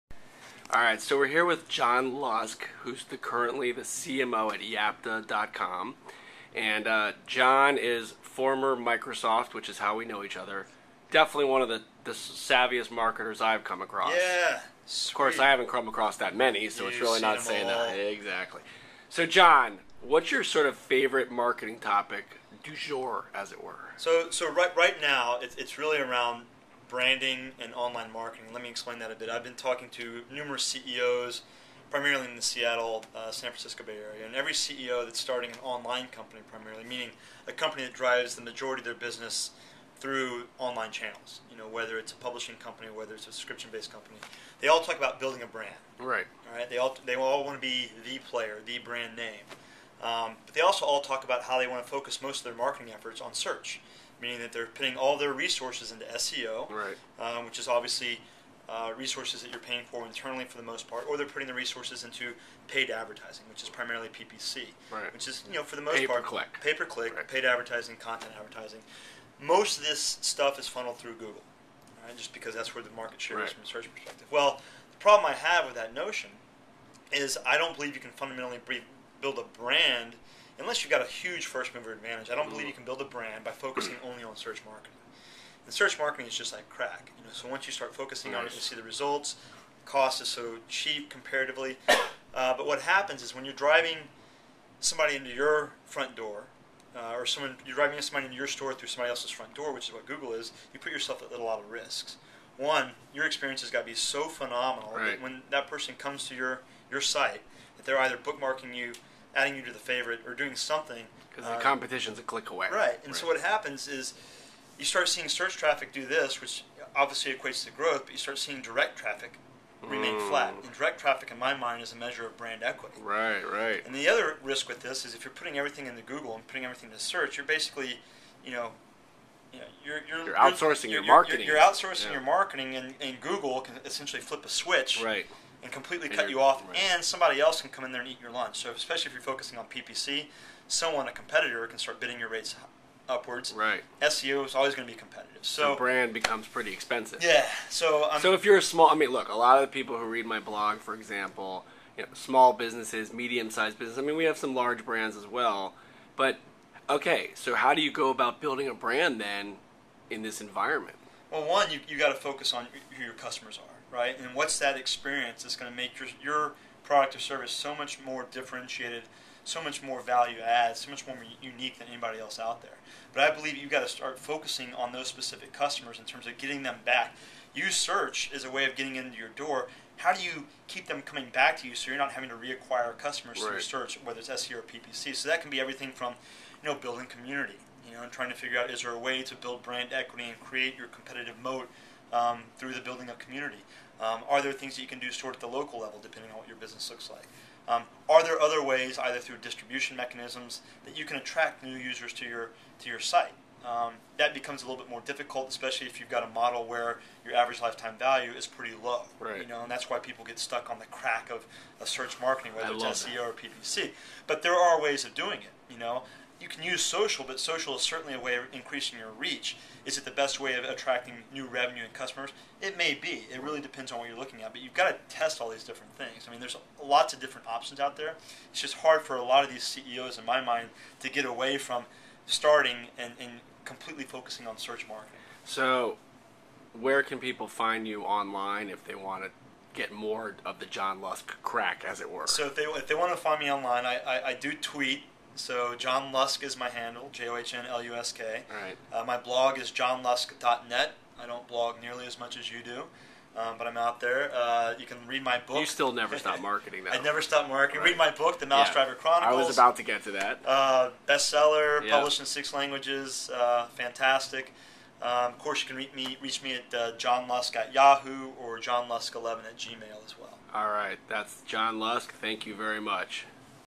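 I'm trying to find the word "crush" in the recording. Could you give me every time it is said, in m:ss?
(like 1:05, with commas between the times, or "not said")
not said.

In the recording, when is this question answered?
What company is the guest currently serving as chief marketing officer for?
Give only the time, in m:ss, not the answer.
0:04.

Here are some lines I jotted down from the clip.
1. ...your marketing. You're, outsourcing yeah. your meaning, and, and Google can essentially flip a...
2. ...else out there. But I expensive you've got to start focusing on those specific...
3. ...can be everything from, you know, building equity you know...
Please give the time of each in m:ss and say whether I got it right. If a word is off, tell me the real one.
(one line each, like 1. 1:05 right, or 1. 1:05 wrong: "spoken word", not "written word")
1. 2:11 wrong: "marketing", not "meaning"
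2. 2:52 wrong: "believe", not "expensive"
3. 3:05 wrong: "community", not "equity".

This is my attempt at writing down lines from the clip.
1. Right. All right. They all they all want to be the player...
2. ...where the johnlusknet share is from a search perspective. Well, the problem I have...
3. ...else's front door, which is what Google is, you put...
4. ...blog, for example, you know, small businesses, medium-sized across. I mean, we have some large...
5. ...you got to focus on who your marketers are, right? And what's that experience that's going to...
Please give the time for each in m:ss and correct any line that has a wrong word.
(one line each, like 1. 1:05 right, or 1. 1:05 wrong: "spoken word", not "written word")
1. 0:45 right
2. 1:12 wrong: "market", not "johnlusknet"
3. 1:39 right
4. 2:30 wrong: "business", not "across"
5. 2:41 wrong: "customers", not "marketers".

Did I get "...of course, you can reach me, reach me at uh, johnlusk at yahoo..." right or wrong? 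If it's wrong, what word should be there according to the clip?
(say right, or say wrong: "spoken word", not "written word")
right.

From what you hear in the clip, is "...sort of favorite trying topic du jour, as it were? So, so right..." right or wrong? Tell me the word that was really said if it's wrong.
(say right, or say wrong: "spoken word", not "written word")
wrong: "marketing", not "trying".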